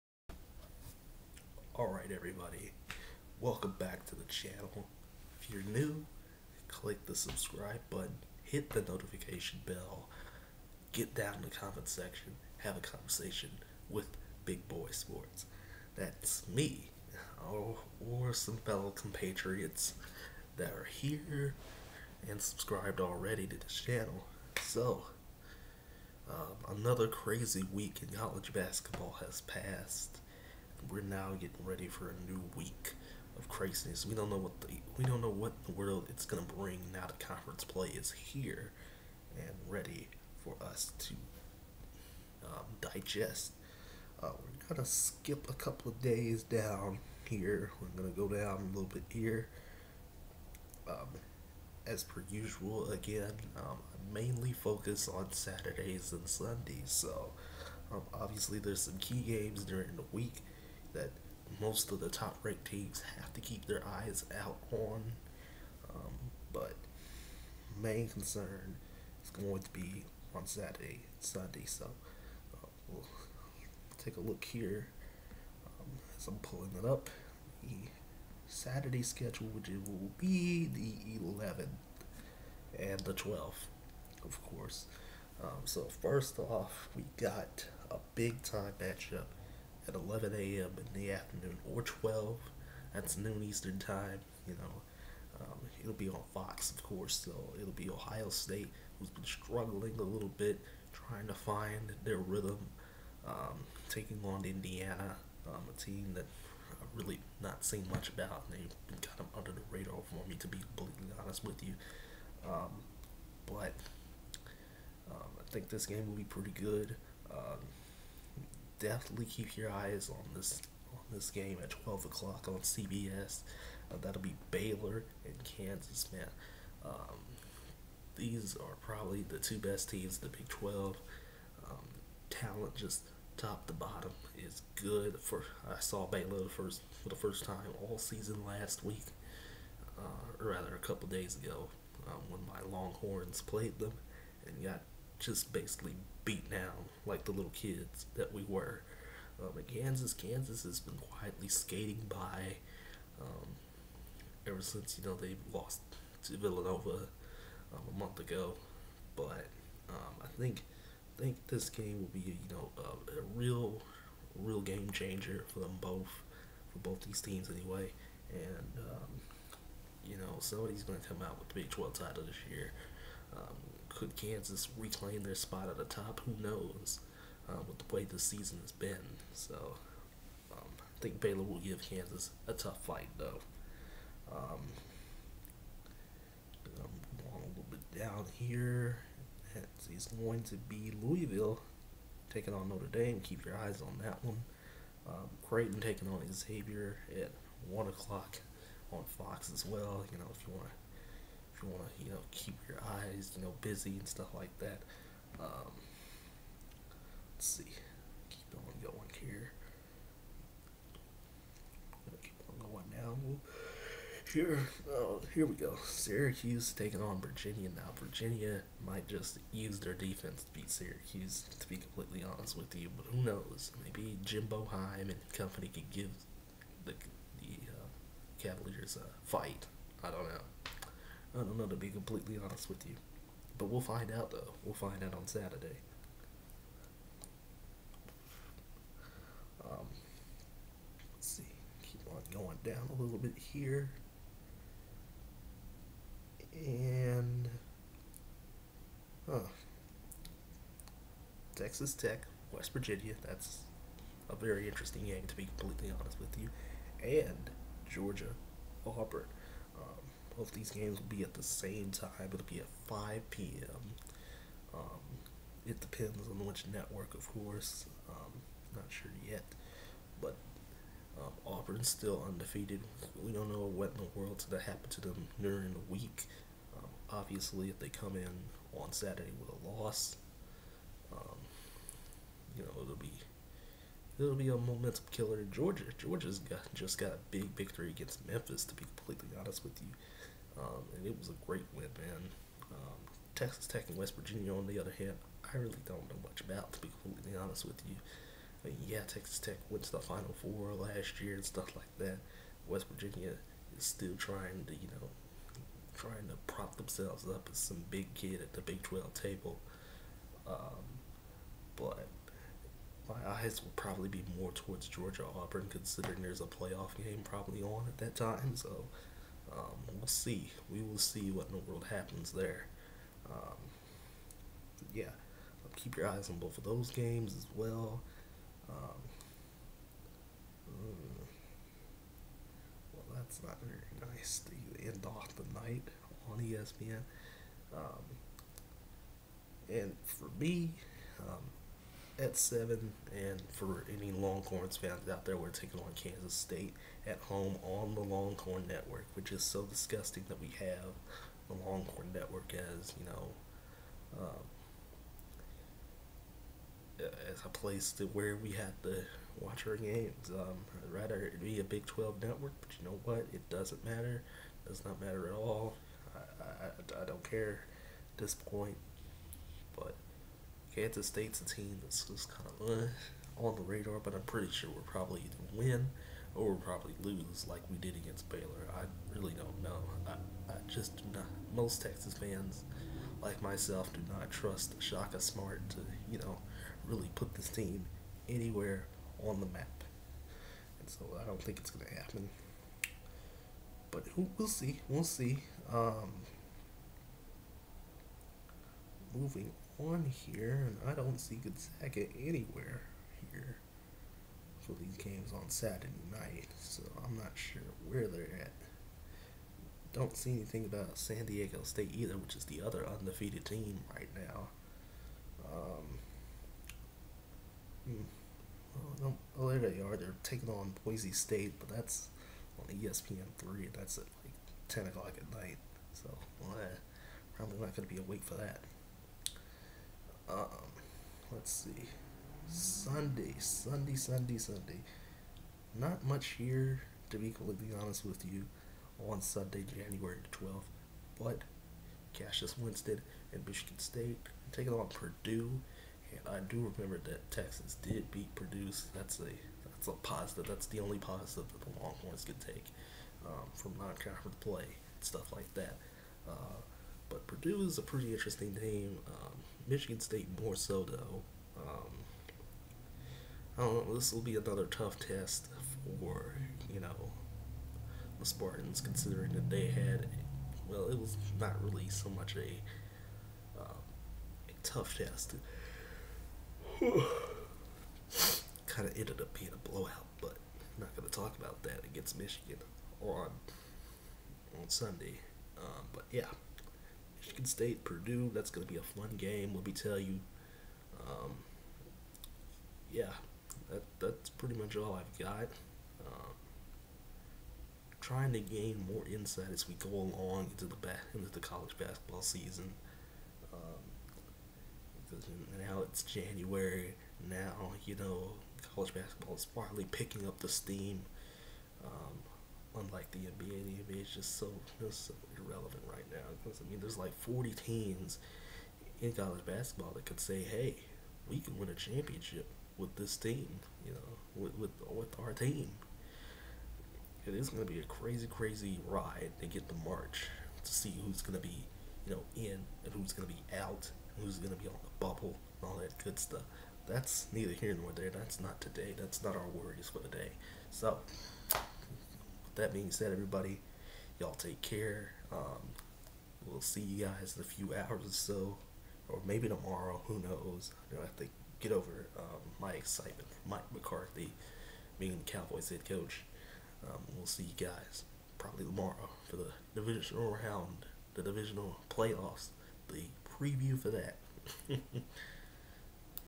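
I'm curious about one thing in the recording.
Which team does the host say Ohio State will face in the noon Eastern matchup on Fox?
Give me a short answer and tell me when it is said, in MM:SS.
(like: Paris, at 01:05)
Indiana, at 01:44.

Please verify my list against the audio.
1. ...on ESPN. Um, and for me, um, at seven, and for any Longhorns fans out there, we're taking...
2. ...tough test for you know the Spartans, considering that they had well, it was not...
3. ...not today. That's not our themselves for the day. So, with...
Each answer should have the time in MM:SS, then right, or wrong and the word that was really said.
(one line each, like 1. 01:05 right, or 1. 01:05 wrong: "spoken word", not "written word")
1. 05:36 right
2. 07:44 right
3. 08:58 wrong: "worries", not "themselves".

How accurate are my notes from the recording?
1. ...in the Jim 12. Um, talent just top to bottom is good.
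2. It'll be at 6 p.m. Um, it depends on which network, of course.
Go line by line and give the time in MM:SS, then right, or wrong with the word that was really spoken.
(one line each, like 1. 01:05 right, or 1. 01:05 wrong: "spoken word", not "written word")
1. 02:10 wrong: "Big", not "Jim"
2. 04:22 wrong: "5", not "6".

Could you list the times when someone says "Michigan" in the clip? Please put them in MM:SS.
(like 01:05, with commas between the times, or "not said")
07:23, 07:39, 08:02, 08:07.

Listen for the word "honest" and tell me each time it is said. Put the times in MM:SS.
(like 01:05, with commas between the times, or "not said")
01:51, 03:42, 03:52, 04:15, 04:49, 04:57, 07:17.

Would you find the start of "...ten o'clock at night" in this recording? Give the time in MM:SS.
07:04.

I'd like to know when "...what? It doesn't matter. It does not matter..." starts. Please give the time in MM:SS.
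06:03.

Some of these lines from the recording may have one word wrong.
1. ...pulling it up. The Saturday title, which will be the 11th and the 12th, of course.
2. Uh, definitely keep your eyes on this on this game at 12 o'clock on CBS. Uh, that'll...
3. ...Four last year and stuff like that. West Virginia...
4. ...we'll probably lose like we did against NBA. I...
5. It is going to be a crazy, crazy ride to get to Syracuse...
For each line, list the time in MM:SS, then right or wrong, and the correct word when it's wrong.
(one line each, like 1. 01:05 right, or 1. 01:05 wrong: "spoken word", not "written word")
1. 01:16 wrong: "schedule", not "title"
2. 01:57 right
3. 05:00 right
4. 06:16 wrong: "Baylor", not "NBA"
5. 08:47 wrong: "March", not "Syracuse".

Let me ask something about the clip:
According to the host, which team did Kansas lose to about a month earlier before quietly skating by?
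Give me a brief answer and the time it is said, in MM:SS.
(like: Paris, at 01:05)
Villanova, at 02:36.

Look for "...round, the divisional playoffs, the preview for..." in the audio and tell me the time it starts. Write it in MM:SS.
09:20.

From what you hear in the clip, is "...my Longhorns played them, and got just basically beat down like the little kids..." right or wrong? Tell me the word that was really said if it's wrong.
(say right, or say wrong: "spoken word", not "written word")
right.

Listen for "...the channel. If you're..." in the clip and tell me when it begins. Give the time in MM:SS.
00:04.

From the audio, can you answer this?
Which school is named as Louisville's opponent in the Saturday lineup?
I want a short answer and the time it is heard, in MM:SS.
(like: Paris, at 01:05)
Notre Dame, at 03:12.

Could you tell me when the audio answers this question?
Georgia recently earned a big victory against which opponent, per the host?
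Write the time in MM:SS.
04:48.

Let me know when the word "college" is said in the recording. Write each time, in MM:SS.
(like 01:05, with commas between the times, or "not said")
00:28, 08:21, 08:28, 08:39.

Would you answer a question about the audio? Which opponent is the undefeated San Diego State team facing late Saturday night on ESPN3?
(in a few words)
Boise State.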